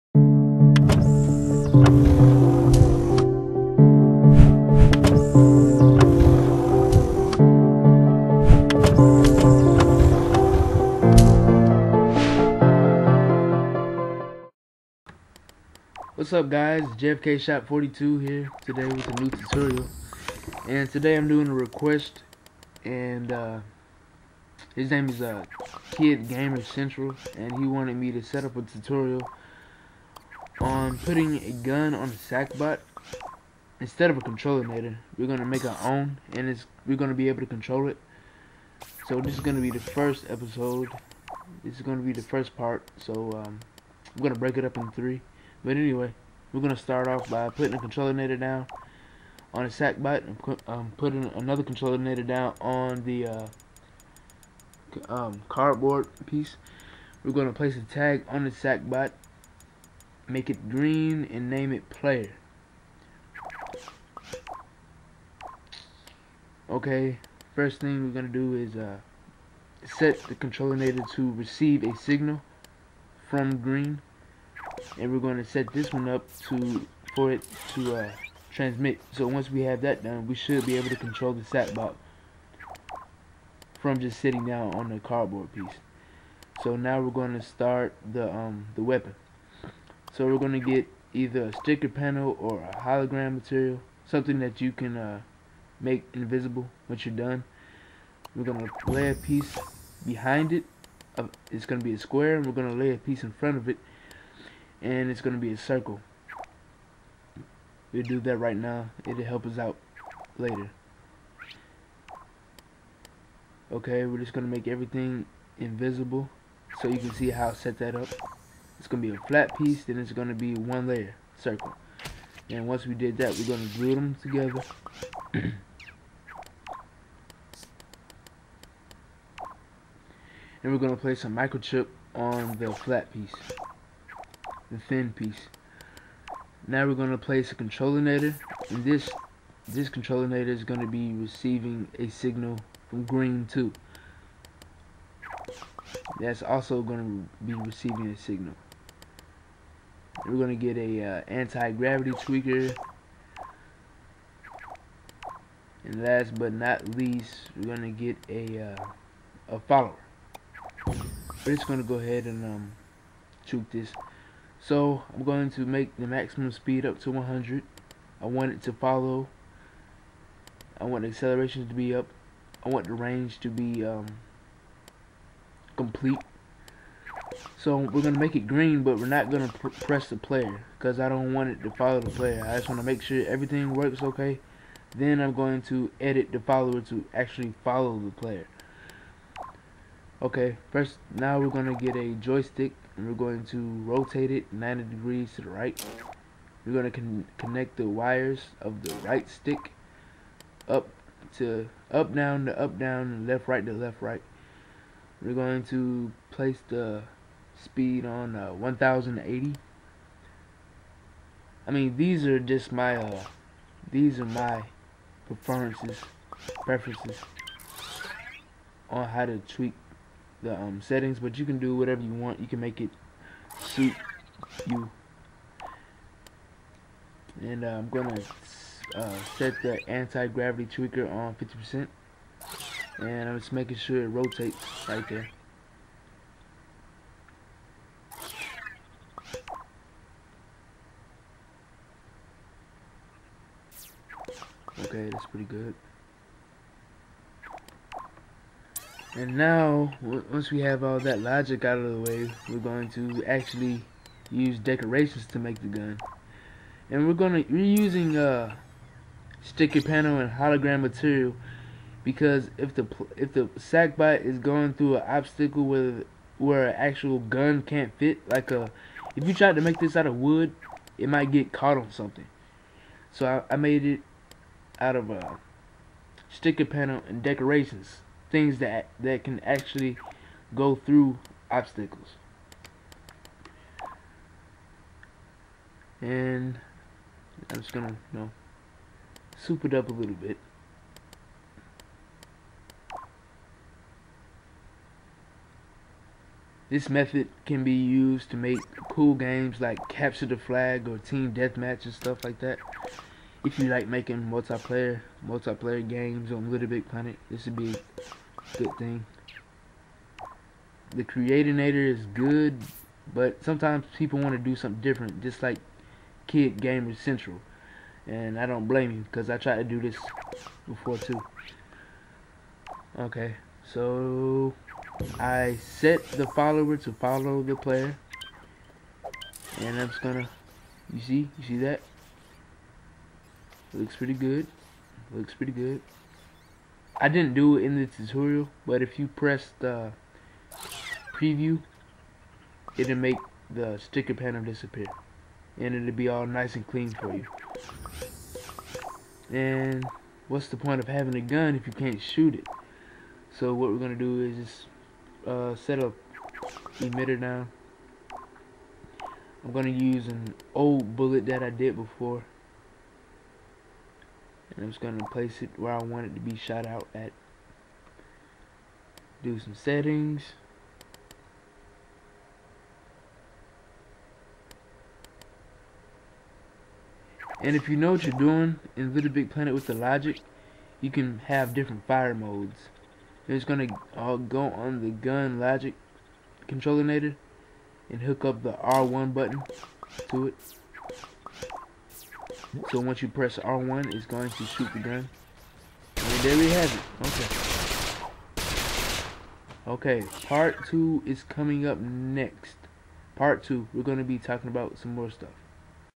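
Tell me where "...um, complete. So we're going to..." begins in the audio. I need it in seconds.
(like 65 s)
173 s.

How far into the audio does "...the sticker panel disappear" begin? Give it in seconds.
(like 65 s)
343 s.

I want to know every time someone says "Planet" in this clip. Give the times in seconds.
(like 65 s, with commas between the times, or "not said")
306 s, 379 s.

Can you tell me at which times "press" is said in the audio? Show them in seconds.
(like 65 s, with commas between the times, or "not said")
179 s, 339 s, 393 s.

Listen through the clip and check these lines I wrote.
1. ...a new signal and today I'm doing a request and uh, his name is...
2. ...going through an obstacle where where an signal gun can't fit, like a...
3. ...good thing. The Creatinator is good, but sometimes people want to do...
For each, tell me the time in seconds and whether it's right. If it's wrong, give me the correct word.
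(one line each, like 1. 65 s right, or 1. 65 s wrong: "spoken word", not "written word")
1. 19 s wrong: "tutorial", not "signal"
2. 264 s wrong: "actual", not "signal"
3. 308 s right.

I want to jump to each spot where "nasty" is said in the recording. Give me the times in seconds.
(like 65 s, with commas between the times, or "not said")
not said.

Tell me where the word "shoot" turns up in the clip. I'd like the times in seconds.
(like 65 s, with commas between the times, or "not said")
352 s, 394 s.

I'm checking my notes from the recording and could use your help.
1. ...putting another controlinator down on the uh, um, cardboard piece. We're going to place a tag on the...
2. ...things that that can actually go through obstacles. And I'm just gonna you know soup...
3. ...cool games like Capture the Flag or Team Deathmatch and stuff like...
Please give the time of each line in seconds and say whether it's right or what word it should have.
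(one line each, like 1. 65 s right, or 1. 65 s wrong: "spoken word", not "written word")
1. 50 s right
2. 278 s right
3. 298 s right.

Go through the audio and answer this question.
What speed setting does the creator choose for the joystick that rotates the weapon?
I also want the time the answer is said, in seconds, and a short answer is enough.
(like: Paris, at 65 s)
1080, at 208 s.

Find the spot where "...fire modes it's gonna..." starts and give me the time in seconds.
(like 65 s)
381 s.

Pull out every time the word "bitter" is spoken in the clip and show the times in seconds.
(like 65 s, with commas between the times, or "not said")
not said.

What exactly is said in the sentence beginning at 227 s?
And uh, I'm gonna uh, set the anti-gravity tweaker on 50%.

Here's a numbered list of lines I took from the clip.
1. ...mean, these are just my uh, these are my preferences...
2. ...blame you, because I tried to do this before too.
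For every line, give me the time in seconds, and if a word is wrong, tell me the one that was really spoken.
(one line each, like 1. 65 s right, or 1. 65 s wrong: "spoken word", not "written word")
1. 211 s right
2. 318 s right.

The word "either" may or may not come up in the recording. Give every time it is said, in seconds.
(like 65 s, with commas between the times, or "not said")
91 s.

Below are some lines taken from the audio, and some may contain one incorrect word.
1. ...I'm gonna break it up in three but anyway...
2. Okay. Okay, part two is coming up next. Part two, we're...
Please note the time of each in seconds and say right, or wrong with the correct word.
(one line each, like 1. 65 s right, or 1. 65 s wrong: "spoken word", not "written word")
1. 44 s right
2. 398 s right.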